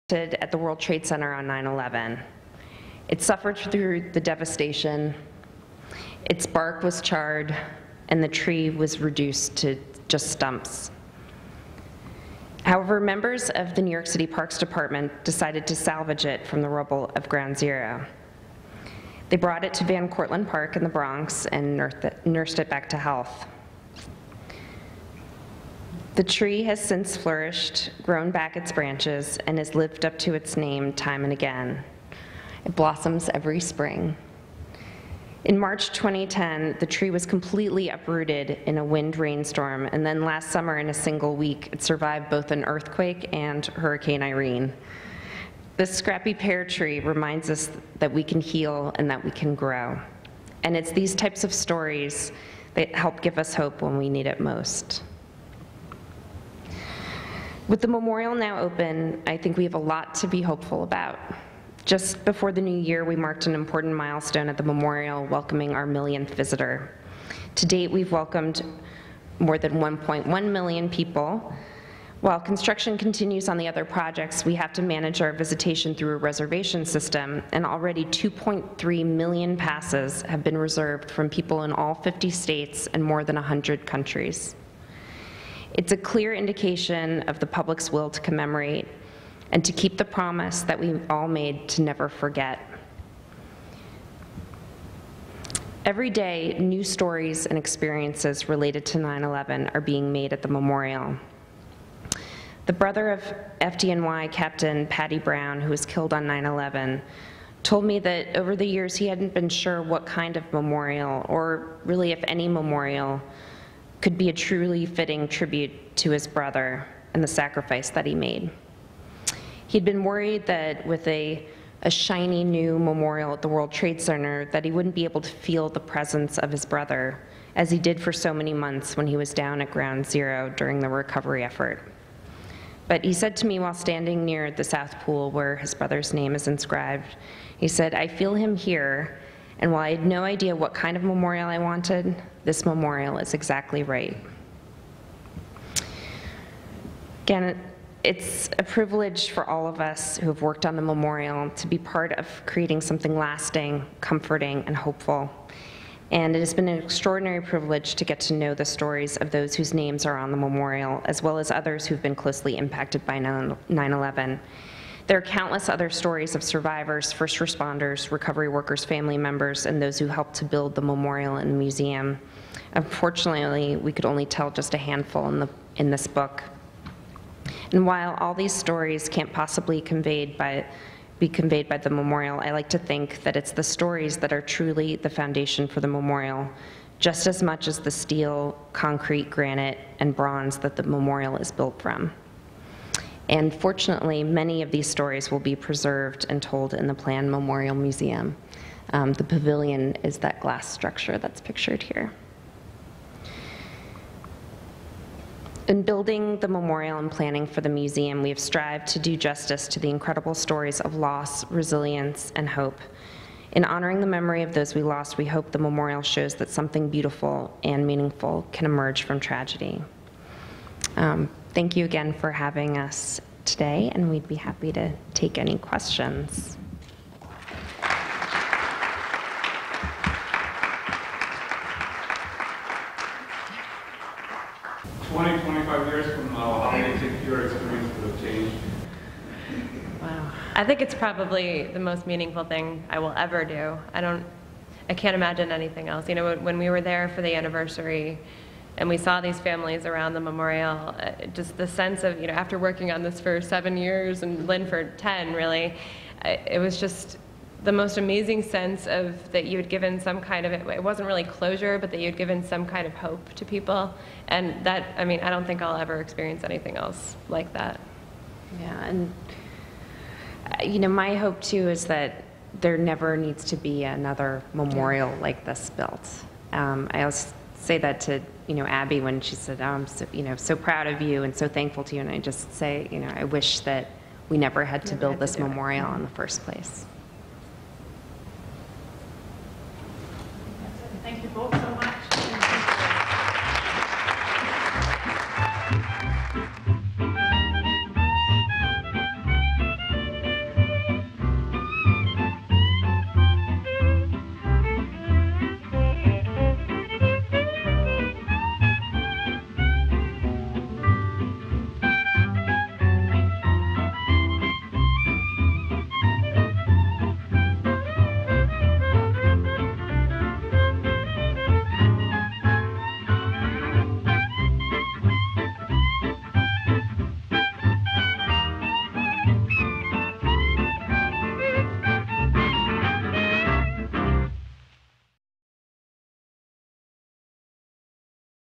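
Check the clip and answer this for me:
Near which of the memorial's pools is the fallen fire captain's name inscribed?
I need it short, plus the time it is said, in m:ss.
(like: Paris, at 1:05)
South Pool, at 2:14.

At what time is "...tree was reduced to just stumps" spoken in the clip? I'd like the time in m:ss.
0:08.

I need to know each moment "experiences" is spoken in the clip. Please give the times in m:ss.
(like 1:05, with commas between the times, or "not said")
1:37, 4:26.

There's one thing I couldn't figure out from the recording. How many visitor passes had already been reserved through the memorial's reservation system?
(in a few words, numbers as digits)
2.3 million.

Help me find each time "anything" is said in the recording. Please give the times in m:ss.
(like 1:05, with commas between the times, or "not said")
4:05, 4:26.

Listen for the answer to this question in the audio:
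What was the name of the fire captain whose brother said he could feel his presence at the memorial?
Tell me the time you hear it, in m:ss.
1:44.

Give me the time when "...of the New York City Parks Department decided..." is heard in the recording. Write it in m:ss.
0:13.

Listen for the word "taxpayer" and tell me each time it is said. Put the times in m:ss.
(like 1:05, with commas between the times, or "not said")
not said.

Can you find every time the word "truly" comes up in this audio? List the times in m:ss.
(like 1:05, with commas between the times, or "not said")
1:54, 3:04.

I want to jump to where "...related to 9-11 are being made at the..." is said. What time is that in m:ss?
1:38.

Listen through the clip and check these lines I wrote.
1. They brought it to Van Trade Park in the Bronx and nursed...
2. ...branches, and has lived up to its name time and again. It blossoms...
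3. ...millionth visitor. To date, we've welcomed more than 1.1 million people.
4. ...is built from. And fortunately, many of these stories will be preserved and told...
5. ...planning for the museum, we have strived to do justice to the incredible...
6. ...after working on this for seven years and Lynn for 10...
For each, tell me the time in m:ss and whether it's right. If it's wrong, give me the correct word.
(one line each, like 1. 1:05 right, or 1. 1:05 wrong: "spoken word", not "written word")
1. 0:19 wrong: "Cortlandt", not "Trade"
2. 0:28 right
3. 1:05 right
4. 3:11 right
5. 3:27 right
6. 4:12 right.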